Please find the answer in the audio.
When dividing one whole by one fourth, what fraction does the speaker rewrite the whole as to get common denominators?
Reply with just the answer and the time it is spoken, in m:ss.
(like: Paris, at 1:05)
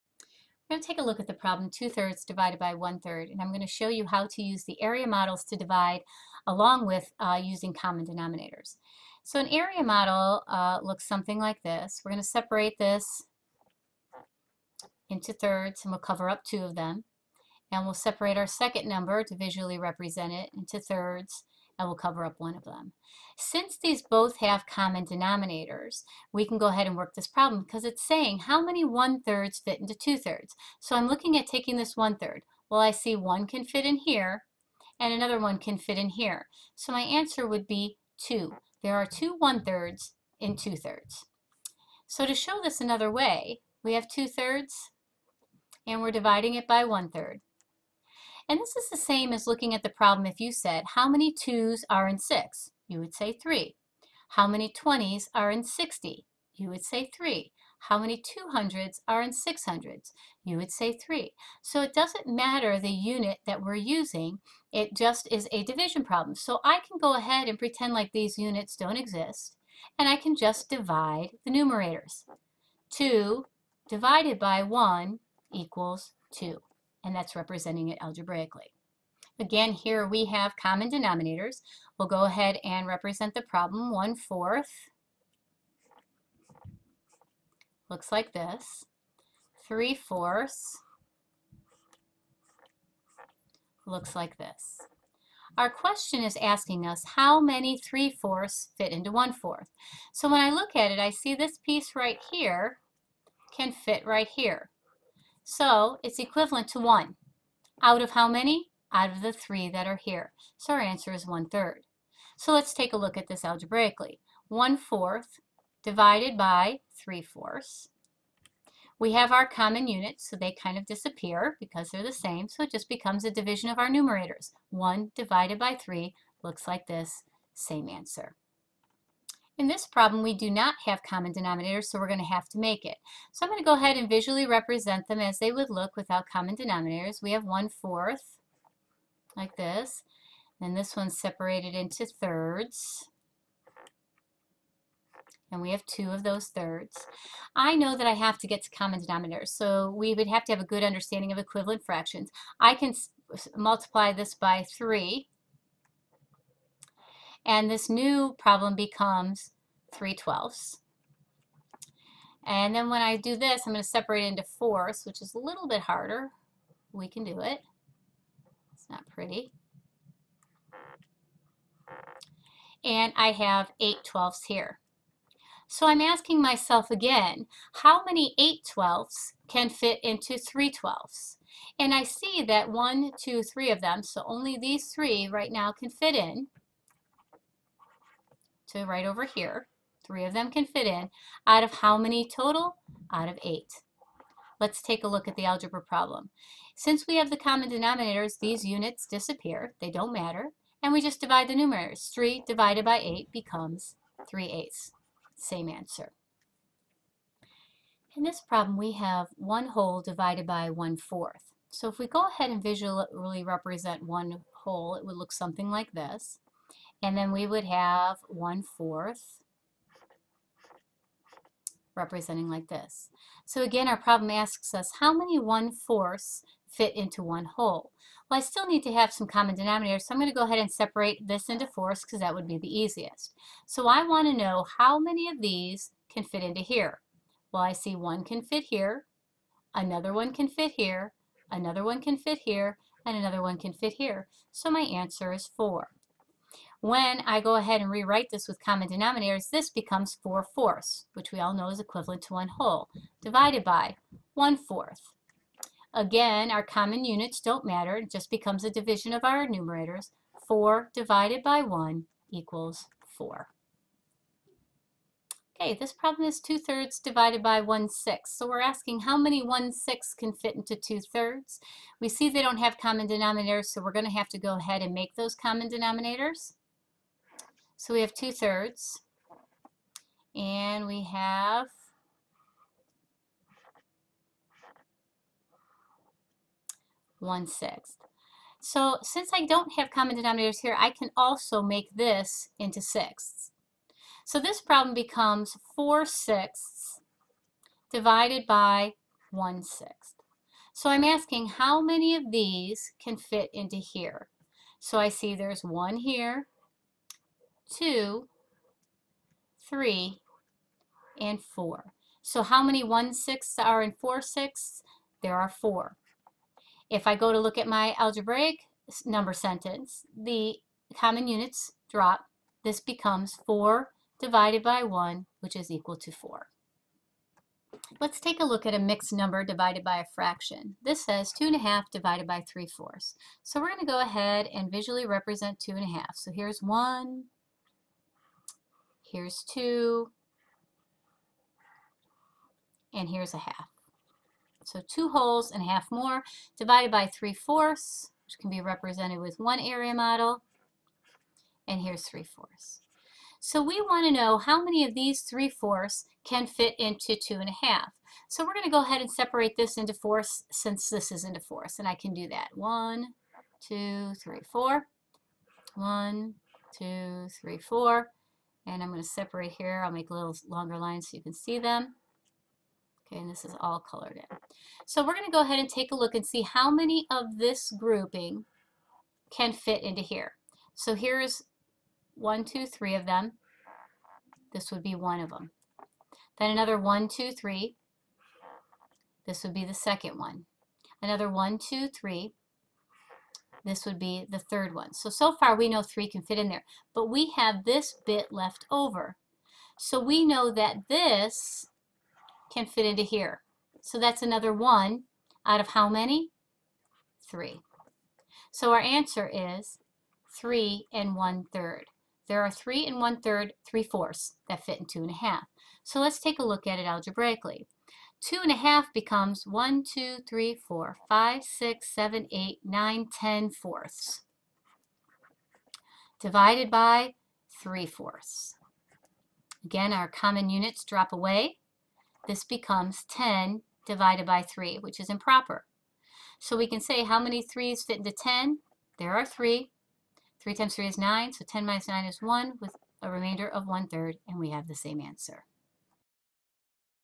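4 fourths, at 4:10.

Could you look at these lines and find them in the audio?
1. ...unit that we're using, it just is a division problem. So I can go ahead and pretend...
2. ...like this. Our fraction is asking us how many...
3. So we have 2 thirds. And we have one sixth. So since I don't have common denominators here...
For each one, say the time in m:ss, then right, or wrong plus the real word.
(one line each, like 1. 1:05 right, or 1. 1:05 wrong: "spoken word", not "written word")
1. 1:02 right
2. 1:34 wrong: "question", not "fraction"
3. 4:37 right.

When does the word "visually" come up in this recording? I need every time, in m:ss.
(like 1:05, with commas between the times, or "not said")
0:19, 2:14, 3:32, 5:34.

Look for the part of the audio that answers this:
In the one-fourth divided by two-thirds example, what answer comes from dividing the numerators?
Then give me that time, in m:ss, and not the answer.
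3:24.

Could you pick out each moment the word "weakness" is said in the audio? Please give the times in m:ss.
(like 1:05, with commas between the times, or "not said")
not said.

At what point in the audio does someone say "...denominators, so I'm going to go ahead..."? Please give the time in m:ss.
3:49.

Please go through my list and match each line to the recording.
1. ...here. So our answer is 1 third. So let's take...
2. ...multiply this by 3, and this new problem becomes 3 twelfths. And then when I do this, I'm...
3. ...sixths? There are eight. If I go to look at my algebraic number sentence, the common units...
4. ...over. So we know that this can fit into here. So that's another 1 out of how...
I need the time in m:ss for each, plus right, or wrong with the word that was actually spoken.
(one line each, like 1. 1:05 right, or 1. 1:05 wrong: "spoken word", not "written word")
1. 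1:50 right
2. 2:33 right
3. 5:14 wrong: "four", not "eight"
4. 6:38 right.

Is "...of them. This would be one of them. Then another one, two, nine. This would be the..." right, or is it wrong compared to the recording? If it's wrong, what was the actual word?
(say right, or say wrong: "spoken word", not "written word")
wrong: "three", not "nine".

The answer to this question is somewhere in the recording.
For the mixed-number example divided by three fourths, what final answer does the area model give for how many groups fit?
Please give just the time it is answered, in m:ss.
6:50.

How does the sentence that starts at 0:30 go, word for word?
So I'm looking at taking this one-third.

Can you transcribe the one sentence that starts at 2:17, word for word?
We have 1 fourth, like this, and this one's separated into thirds.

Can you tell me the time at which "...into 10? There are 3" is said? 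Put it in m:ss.
7:17.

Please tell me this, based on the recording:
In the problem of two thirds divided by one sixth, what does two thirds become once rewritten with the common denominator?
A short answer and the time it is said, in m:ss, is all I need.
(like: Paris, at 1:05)
4 sixths, at 4:55.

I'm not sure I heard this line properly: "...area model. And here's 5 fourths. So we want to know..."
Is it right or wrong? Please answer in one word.
wrong.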